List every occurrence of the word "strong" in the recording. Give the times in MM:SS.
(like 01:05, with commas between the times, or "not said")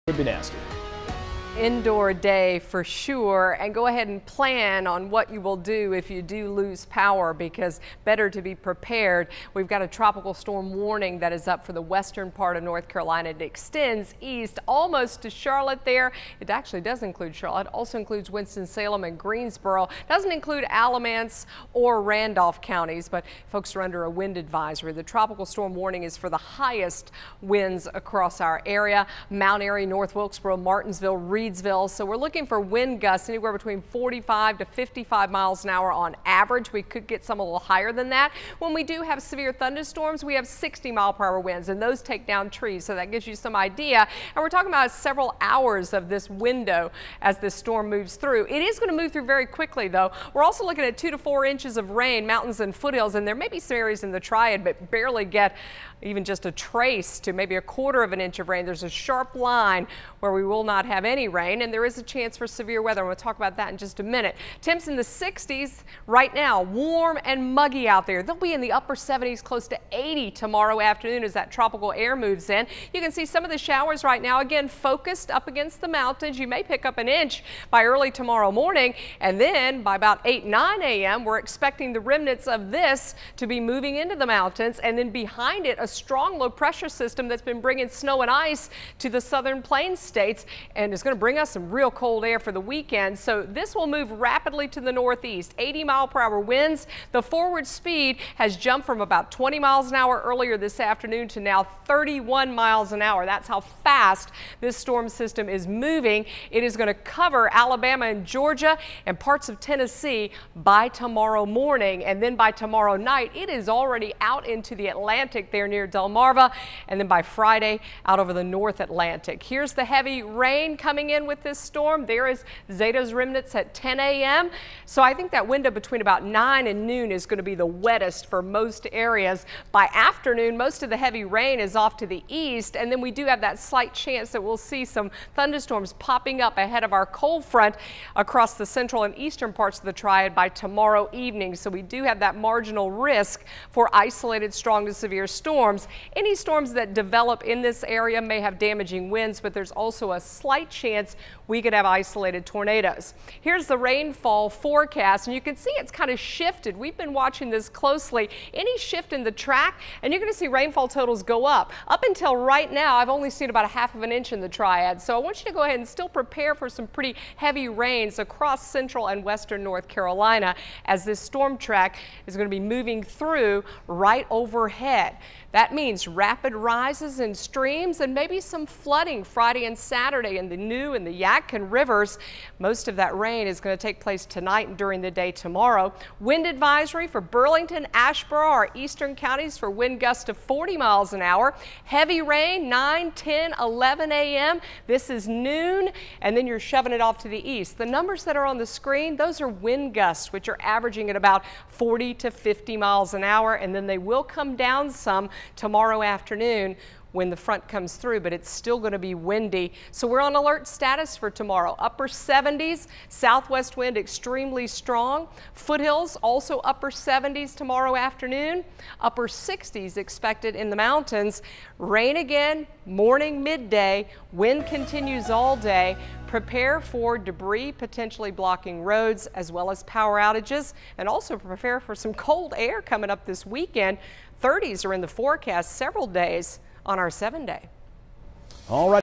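01:25, 02:24, 03:34.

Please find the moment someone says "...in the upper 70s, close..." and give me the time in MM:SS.
01:08.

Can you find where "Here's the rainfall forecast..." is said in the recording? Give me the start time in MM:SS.
02:33.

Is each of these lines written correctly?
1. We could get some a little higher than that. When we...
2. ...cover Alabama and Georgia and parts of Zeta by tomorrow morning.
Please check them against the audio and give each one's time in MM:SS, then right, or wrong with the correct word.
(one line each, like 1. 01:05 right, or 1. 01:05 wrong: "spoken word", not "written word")
1. 00:36 right
2. 01:46 wrong: "Tennessee", not "Zeta".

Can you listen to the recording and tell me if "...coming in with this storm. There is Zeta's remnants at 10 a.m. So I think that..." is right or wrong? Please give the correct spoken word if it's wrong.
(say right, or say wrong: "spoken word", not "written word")
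right.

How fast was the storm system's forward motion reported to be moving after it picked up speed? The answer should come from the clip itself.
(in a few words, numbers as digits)
31 mph.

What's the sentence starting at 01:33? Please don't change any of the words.
So this will move rapidly to the northeast.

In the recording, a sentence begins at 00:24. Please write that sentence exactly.
The tropical storm warning is for the highest winds across our area.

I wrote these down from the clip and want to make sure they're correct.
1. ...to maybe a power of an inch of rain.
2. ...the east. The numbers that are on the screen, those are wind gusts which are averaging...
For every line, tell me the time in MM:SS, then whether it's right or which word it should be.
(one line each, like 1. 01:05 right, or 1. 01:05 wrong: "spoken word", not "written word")
1. 00:57 wrong: "quarter", not "power"
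2. 03:17 right.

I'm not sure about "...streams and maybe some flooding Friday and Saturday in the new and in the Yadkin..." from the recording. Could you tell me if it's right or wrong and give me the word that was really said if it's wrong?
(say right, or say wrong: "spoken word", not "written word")
right.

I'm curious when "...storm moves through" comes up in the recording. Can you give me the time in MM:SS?
00:47.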